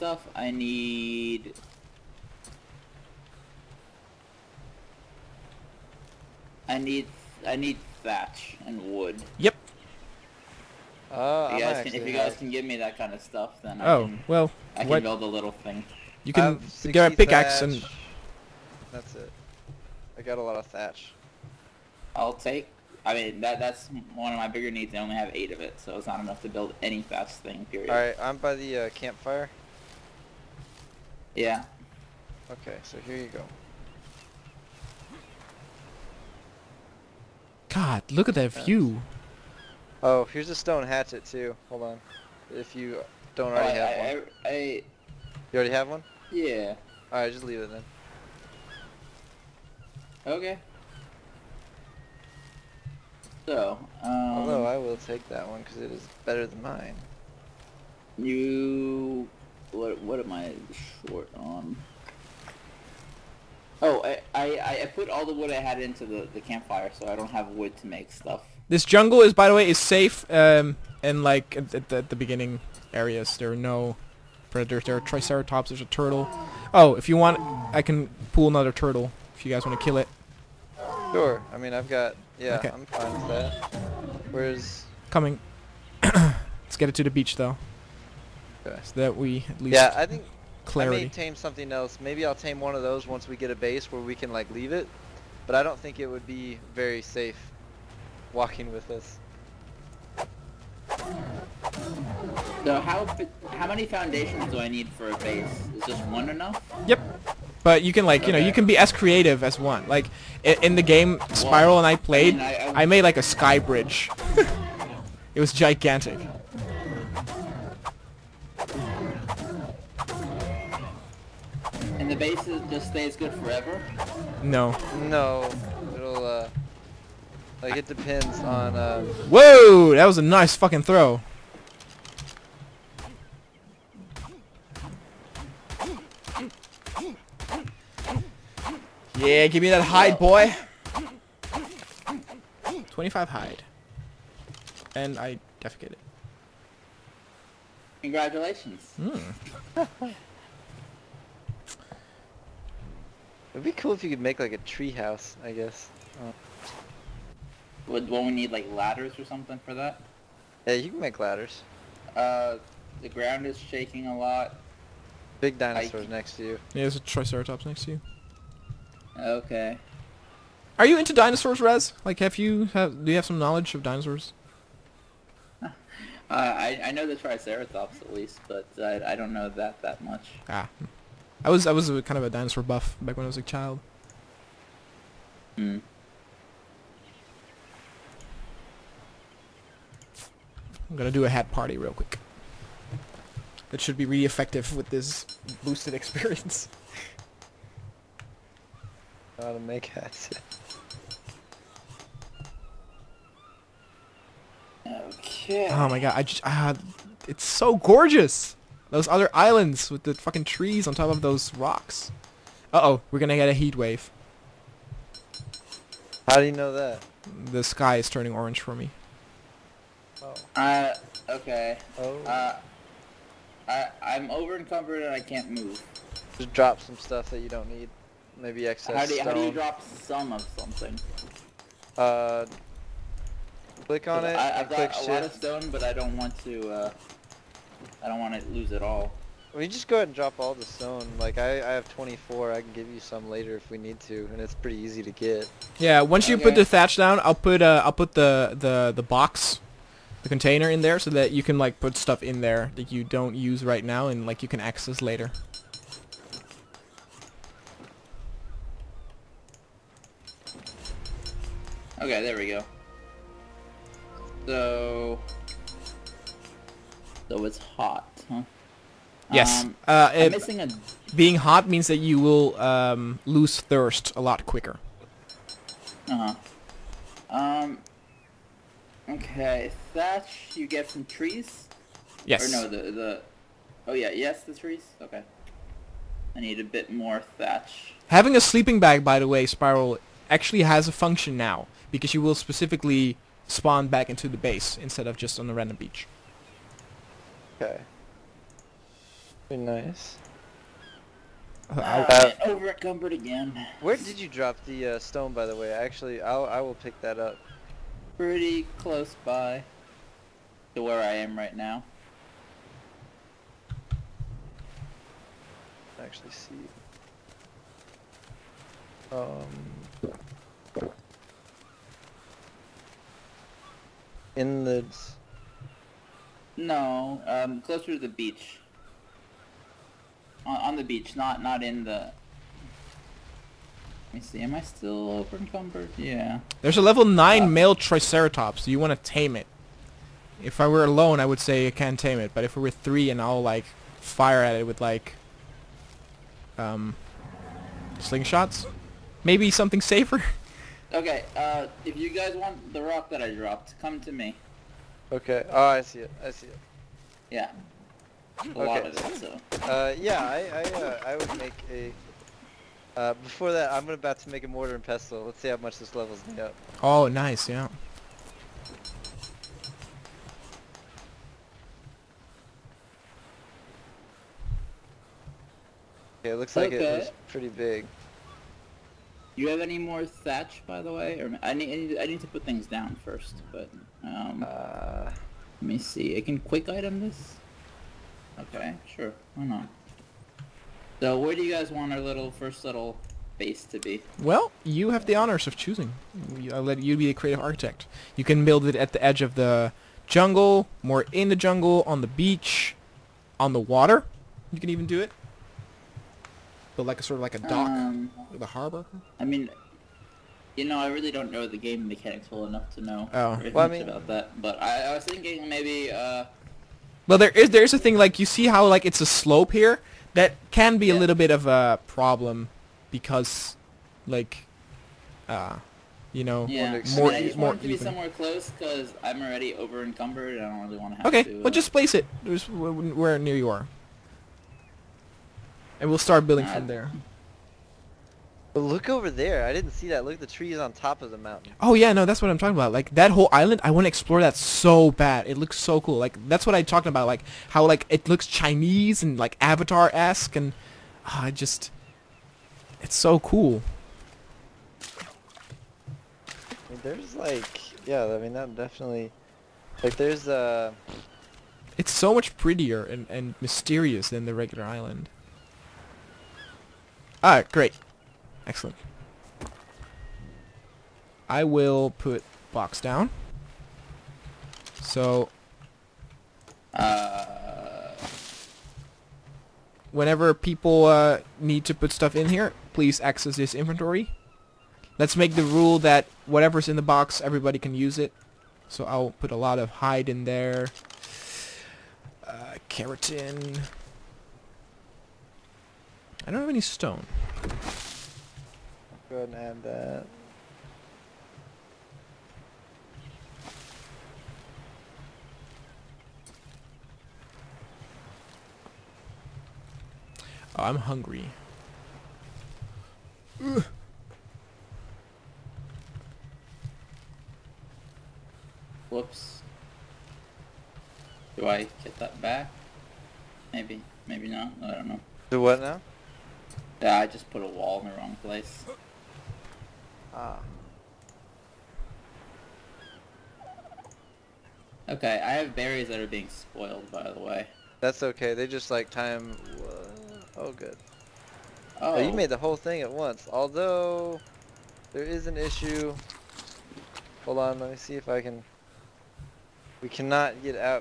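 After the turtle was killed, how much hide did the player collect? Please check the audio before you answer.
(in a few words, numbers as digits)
25.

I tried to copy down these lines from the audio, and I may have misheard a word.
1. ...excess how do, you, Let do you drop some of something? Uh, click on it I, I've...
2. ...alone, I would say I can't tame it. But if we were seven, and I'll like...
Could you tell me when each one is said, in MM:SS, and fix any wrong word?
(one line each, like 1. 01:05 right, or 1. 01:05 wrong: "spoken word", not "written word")
1. 03:48 wrong: "How", not "Let"
2. 05:40 wrong: "three", not "seven".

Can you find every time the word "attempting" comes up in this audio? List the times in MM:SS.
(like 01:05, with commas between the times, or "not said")
not said.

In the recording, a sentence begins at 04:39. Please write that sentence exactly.
Okay, thatch you get from trees.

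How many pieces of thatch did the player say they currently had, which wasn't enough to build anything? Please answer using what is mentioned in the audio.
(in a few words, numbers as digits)
8.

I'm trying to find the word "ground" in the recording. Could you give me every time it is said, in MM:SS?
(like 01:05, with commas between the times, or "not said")
02:43.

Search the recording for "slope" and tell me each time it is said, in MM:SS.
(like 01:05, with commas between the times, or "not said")
06:59.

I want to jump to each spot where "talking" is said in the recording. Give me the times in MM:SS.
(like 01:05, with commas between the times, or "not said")
07:22, 07:26.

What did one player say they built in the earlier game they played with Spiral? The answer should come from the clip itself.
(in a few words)
a sky bridge.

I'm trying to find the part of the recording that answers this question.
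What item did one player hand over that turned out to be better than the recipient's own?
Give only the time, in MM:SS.
00:40.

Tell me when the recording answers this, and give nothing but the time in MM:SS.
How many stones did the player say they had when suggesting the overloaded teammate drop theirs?
04:01.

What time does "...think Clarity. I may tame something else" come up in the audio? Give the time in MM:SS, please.
01:30.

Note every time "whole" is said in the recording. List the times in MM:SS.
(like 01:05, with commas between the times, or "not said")
07:23, 09:02.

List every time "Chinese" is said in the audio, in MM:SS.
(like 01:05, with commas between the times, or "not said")
07:28.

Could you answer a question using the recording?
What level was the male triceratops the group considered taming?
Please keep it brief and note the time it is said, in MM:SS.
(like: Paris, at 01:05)
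9, at 05:36.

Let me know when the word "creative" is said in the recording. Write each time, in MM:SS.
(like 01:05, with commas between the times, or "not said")
01:48, 06:37.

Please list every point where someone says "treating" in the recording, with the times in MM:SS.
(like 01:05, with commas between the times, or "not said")
not said.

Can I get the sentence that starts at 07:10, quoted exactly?
I don't really want to have okay, to.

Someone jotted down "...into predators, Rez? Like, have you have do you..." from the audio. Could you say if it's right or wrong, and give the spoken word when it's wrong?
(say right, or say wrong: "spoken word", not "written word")
wrong: "dinosaurs", not "predators".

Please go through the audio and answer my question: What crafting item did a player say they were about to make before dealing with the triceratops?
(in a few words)
mortar and pestle.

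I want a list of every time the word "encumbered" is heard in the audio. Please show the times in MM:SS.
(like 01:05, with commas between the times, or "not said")
03:44, 05:02, 05:35, 07:09.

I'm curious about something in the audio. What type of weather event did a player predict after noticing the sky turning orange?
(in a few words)
heat wave.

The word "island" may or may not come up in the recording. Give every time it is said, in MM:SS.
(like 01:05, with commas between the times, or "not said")
03:29, 07:23, 07:44.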